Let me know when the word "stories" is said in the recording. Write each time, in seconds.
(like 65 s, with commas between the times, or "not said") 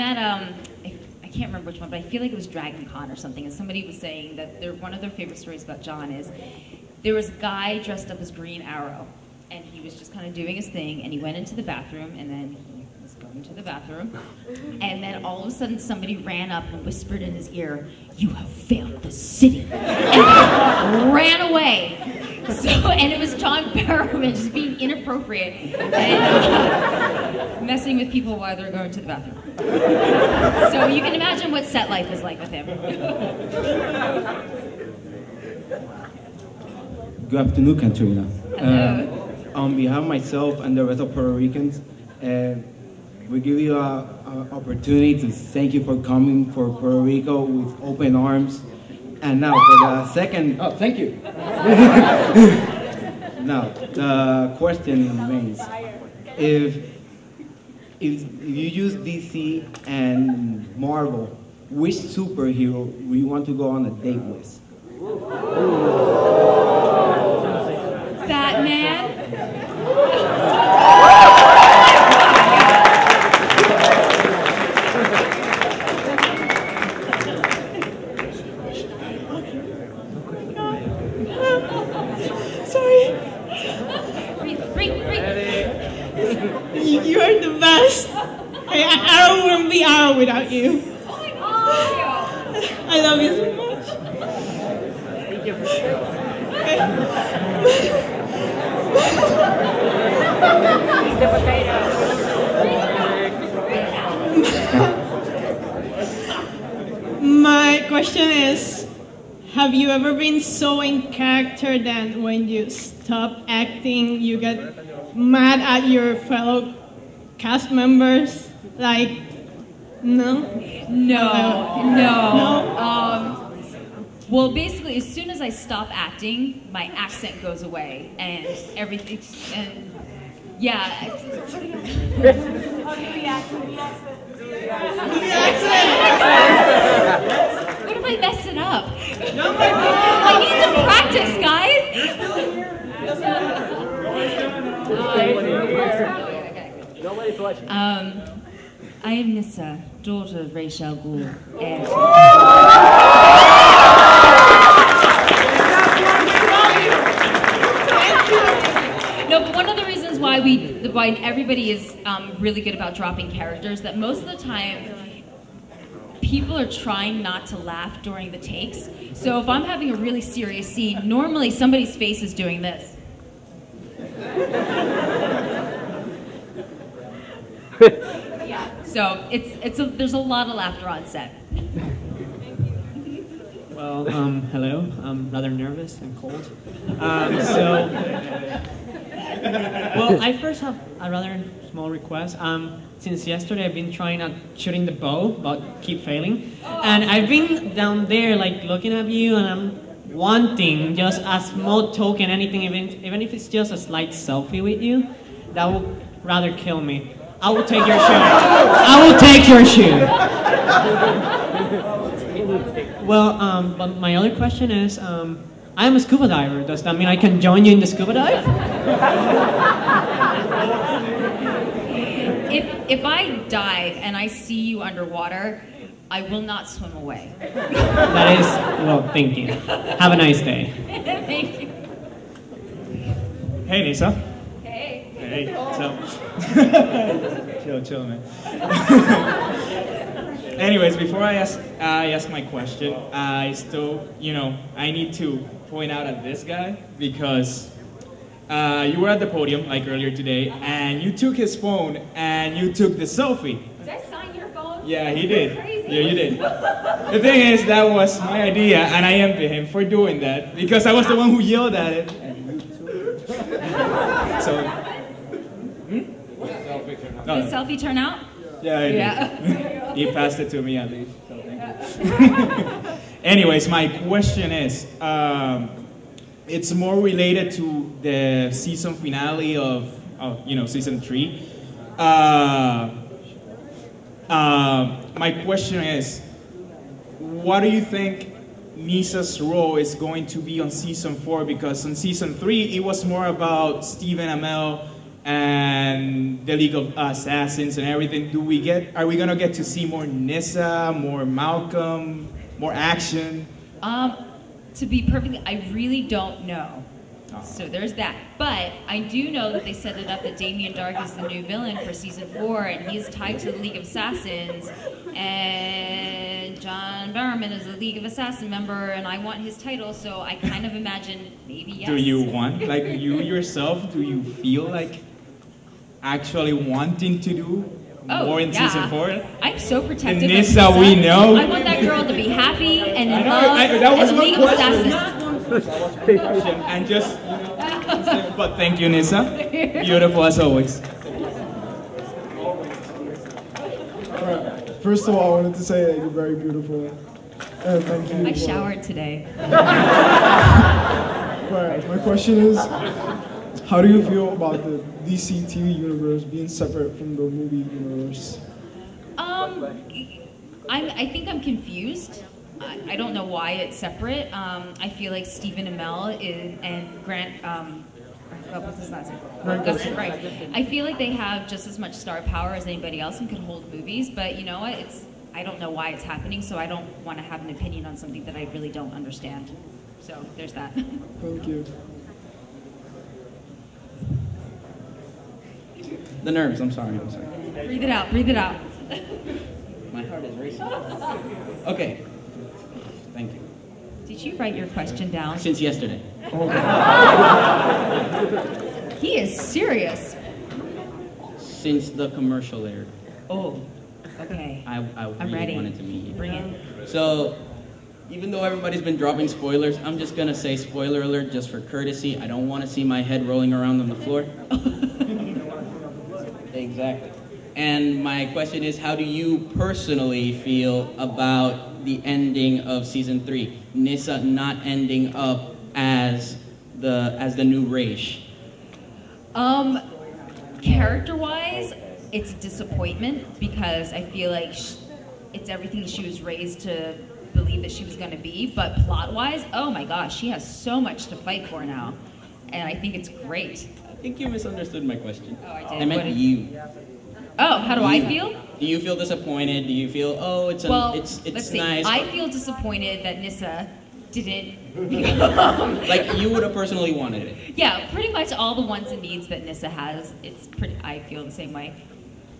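5 s.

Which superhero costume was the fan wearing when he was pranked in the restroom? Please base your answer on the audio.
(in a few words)
Green Arrow.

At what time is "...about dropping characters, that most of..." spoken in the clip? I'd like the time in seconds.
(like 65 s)
162 s.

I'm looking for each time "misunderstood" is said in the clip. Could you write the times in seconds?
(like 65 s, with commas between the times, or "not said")
444 s.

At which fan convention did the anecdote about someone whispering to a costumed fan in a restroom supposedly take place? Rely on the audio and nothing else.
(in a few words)
Dragon Con.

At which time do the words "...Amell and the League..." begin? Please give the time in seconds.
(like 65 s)
294 s.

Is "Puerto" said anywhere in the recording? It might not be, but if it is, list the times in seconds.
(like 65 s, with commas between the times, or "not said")
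41 s, 46 s.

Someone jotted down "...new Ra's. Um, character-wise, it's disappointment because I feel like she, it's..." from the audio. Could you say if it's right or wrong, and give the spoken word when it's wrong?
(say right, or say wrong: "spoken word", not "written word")
right.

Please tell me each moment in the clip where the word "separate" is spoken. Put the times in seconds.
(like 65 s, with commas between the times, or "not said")
356 s, 363 s.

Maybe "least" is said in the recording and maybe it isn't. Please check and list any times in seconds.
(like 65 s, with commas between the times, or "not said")
270 s.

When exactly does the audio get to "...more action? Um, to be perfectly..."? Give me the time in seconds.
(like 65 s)
302 s.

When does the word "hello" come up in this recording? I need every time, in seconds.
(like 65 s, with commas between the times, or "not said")
38 s, 184 s.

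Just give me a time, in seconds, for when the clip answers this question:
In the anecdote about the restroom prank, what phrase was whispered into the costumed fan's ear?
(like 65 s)
18 s.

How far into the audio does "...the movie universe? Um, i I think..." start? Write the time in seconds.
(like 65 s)
357 s.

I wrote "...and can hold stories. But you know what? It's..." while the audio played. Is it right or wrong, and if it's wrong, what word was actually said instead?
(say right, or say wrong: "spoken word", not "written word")
wrong: "movies", not "stories".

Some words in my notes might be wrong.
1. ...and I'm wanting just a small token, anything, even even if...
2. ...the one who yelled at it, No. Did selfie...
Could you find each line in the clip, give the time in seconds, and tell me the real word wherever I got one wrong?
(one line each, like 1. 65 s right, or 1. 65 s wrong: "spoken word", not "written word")
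1. 199 s right
2. 261 s right.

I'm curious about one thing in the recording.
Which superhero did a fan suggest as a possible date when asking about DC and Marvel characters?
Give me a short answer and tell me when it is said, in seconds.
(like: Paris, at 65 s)
Batman, at 68 s.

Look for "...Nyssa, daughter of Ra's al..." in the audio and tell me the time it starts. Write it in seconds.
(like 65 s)
149 s.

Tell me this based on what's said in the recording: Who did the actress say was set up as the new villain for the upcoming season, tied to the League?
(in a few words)
Damien Darhk.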